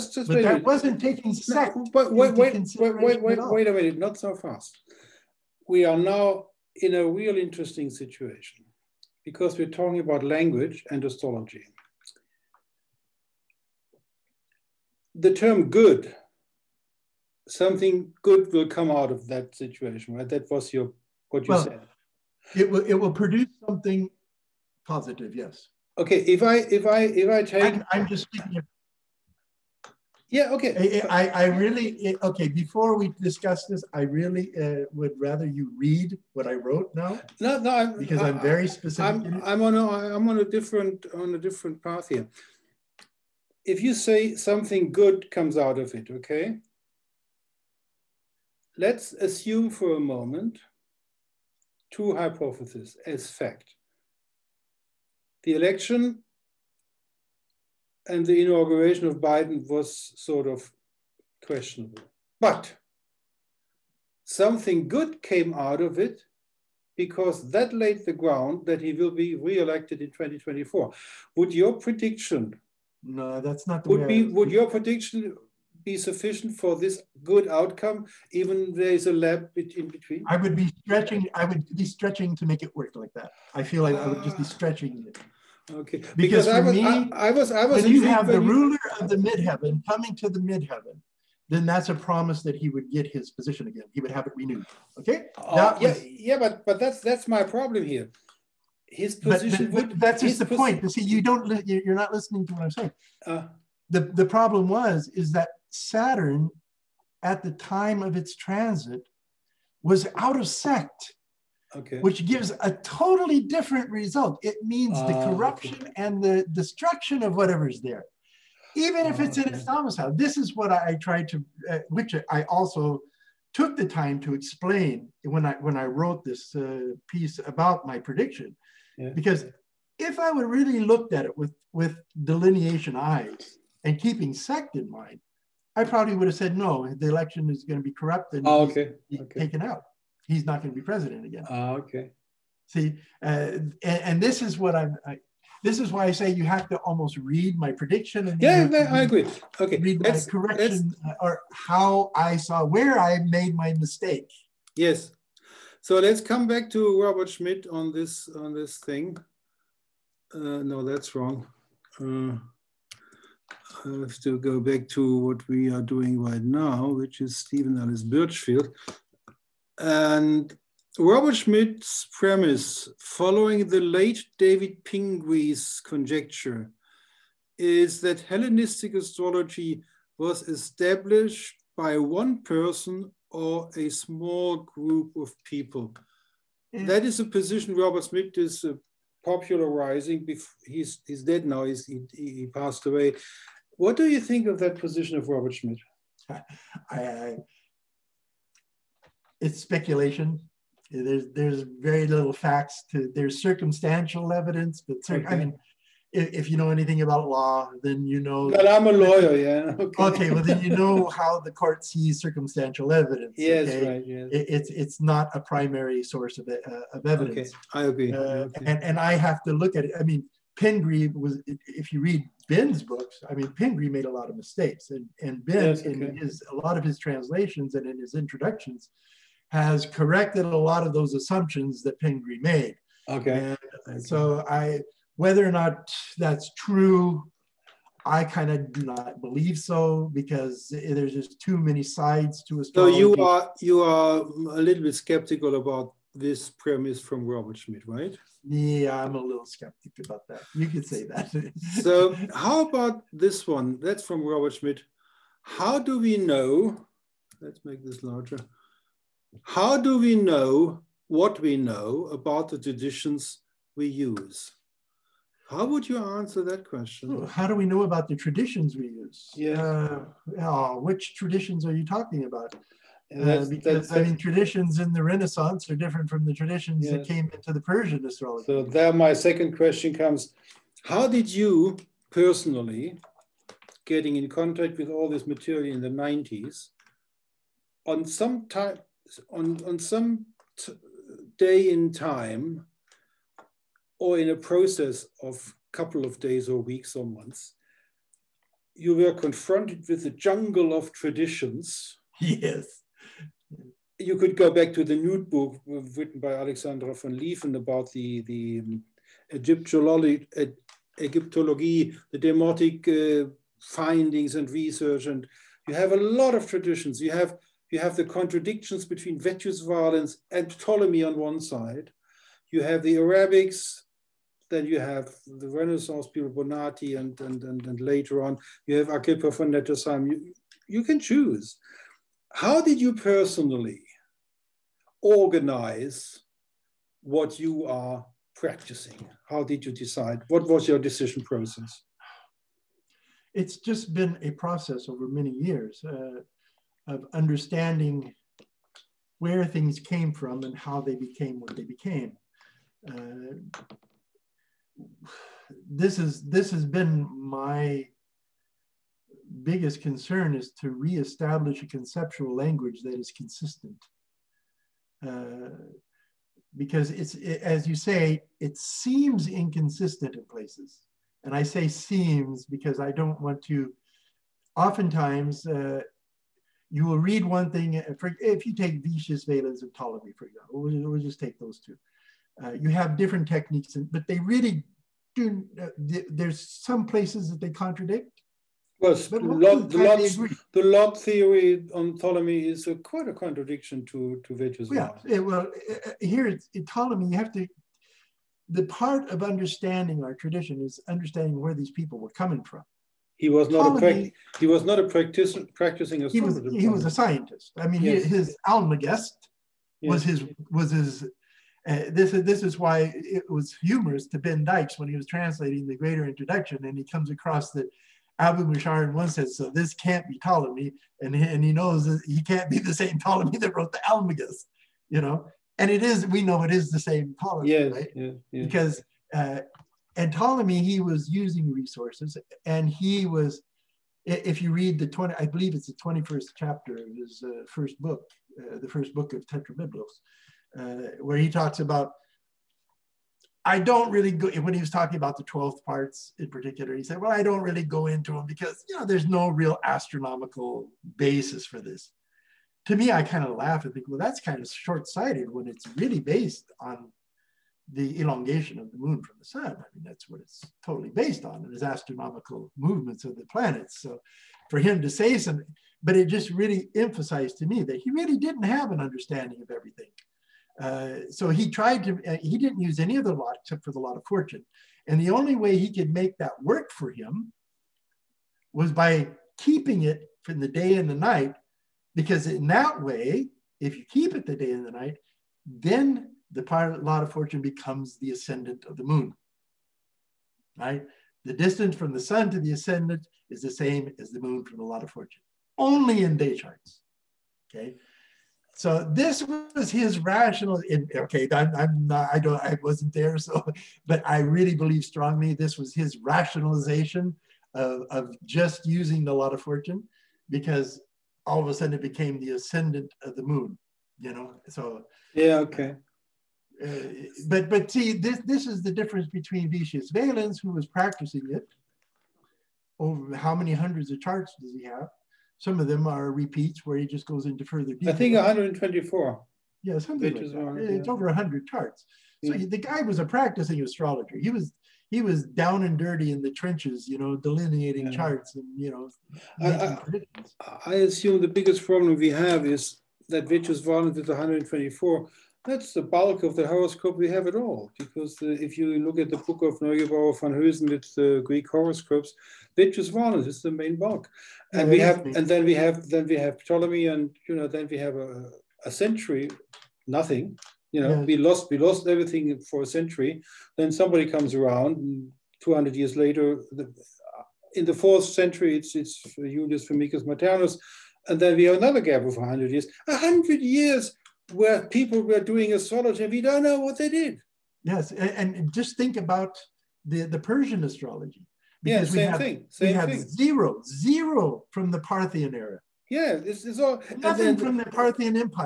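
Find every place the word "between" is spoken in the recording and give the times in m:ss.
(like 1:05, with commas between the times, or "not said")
1:19, 5:18, 8:39.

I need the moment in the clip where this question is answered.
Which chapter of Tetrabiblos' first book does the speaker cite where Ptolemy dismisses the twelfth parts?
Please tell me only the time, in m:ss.
7:15.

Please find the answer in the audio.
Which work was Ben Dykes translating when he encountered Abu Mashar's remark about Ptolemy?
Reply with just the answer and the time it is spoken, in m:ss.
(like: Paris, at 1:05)
Greater Introduction, at 6:55.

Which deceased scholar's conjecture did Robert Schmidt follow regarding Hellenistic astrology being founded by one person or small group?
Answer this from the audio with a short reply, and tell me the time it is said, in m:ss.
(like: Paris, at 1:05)
David Pingree, at 2:54.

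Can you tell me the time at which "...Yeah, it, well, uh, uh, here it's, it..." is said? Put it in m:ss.
6:34.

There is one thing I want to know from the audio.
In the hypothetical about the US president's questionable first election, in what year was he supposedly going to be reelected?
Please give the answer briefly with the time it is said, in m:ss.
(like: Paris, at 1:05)
2024, at 1:10.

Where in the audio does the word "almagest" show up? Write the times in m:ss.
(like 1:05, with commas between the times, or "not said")
6:48, 7:03.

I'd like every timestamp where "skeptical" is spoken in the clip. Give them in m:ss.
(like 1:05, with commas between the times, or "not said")
4:04, 4:09.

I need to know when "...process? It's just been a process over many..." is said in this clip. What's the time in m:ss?
5:41.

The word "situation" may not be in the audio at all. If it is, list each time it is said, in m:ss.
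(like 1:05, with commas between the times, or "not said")
0:07, 0:19.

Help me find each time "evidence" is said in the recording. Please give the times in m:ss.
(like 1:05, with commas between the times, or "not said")
3:24, 3:32, 3:37.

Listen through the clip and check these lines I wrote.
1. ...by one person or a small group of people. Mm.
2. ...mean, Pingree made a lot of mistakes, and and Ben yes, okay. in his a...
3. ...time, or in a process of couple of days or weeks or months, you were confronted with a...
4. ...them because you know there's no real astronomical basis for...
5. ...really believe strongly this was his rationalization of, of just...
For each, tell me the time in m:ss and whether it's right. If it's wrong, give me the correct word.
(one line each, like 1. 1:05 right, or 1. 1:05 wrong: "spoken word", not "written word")
1. 3:01 right
2. 3:43 right
3. 4:51 right
4. 7:28 right
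5. 8:24 right.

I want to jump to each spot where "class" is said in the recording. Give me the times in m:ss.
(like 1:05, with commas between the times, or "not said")
not said.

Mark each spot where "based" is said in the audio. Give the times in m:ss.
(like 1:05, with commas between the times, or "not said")
7:35, 7:40.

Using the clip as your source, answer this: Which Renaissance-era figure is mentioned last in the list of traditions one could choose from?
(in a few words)
Agrippa von Nettesheim.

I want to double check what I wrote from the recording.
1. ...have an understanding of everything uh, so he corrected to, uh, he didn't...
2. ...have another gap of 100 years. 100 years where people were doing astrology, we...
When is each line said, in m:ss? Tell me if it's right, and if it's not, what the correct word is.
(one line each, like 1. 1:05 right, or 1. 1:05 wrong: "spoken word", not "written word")
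1. 7:48 wrong: "tried", not "corrected"
2. 9:31 right.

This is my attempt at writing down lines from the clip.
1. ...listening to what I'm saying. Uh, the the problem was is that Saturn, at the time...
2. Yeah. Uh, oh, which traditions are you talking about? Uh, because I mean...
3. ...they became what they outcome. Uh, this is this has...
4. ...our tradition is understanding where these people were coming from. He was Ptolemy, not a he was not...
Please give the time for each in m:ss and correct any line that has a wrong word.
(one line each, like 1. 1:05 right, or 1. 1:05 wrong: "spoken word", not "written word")
1. 1:42 right
2. 4:29 right
3. 5:50 wrong: "became", not "outcome"
4. 6:40 right.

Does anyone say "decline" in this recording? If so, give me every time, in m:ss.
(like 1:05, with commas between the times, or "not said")
not said.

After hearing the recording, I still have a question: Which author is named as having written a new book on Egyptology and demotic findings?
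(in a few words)
Alexandra von Lieven.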